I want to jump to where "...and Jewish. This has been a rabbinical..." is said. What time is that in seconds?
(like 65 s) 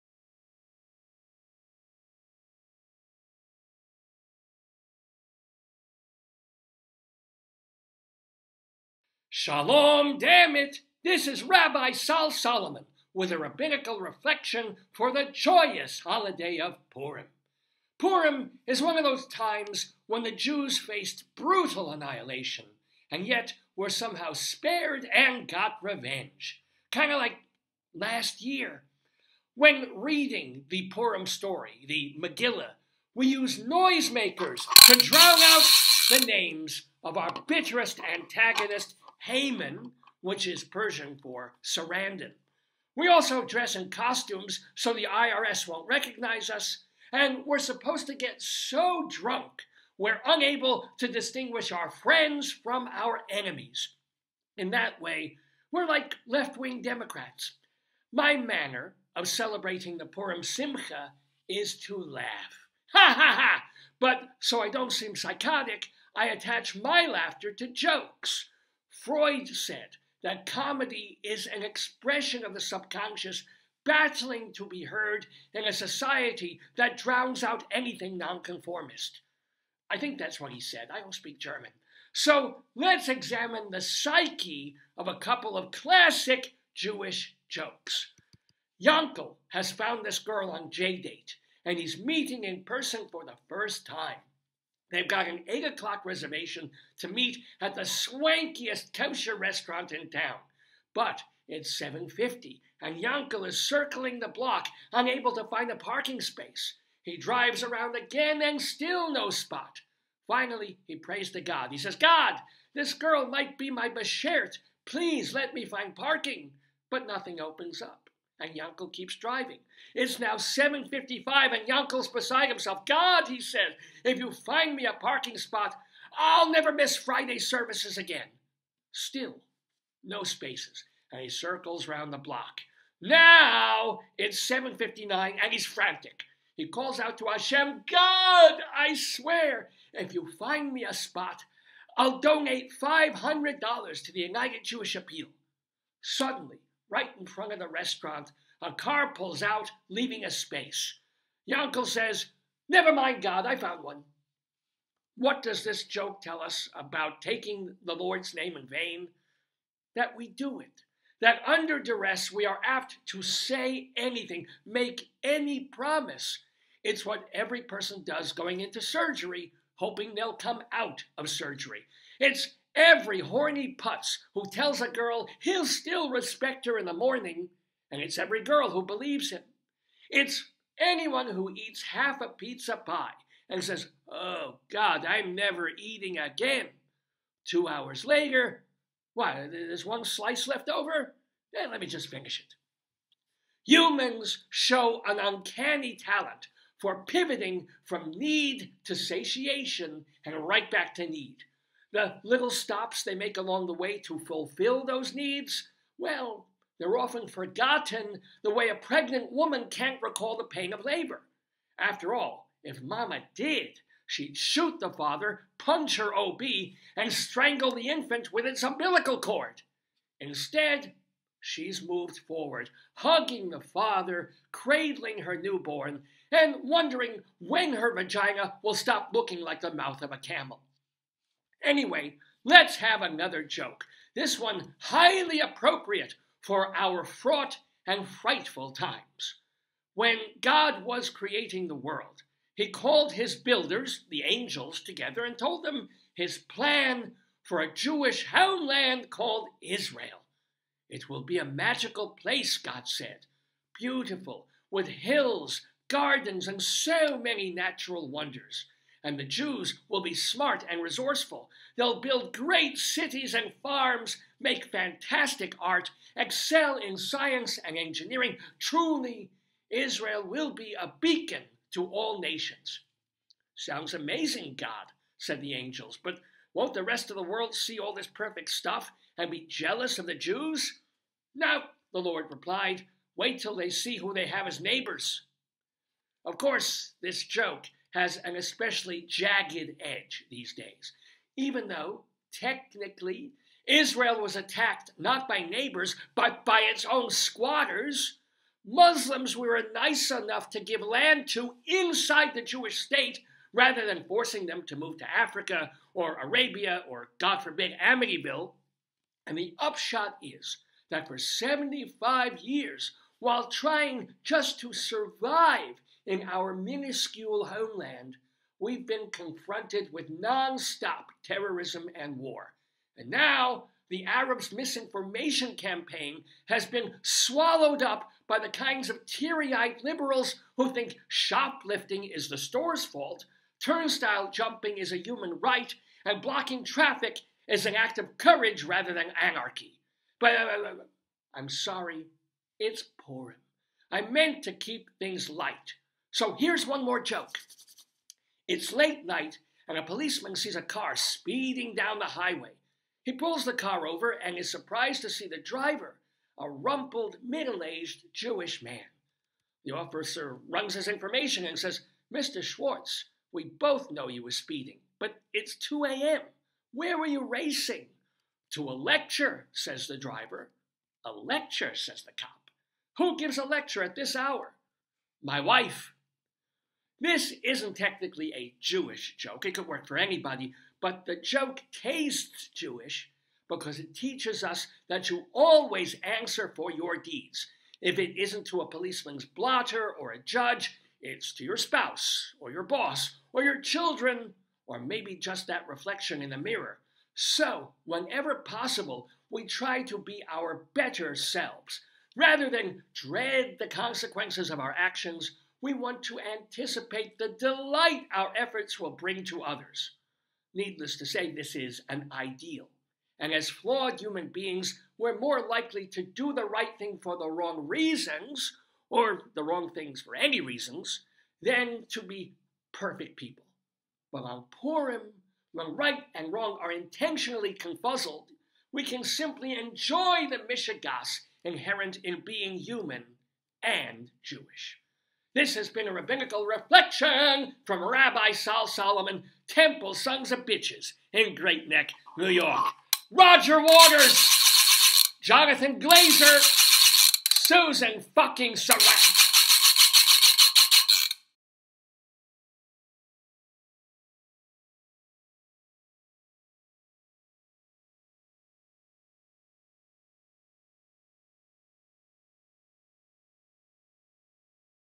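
433 s.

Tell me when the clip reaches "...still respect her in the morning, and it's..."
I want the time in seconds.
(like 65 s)
175 s.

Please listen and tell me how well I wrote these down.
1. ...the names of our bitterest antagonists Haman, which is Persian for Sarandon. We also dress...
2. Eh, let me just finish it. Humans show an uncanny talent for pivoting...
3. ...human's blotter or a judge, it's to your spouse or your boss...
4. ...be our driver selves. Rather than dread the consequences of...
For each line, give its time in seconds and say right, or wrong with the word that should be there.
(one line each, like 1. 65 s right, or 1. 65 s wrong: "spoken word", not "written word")
1. 36 s right
2. 191 s right
3. 388 s wrong: "policeman", not "human"
4. 399 s wrong: "better", not "driver".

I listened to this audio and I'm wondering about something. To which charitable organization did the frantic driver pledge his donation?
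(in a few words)
United Jewish Appeal.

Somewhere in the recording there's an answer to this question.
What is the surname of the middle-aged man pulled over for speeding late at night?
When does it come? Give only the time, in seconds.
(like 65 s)
362 s.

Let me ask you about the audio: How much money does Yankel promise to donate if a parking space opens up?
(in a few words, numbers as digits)
$500.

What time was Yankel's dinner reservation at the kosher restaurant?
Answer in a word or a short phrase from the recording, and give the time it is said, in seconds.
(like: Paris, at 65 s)
8 o'clock, at 95 s.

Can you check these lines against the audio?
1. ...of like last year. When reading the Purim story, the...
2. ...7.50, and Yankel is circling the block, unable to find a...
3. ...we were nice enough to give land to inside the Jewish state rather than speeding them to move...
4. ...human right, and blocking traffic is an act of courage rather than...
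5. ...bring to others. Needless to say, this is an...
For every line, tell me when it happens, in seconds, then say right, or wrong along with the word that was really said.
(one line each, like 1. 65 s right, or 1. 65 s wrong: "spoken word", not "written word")
1. 27 s right
2. 101 s right
3. 299 s wrong: "forcing", not "speeding"
4. 335 s right
5. 408 s right.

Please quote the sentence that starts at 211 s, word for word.
After all, if Mama did, she'd shoot the father, punch her OB, and strangle the infant with its umbilical cord.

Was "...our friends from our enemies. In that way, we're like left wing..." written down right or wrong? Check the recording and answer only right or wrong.
right.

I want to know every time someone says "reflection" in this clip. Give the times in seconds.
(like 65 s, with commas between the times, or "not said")
14 s, 395 s, 436 s.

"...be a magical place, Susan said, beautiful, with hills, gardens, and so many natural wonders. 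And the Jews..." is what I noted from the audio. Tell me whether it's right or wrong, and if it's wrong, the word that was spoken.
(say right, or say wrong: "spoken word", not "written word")
wrong: "God", not "Susan".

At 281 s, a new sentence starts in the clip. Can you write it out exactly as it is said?
No, the Lord replied, wait till they see who they have as neighbors.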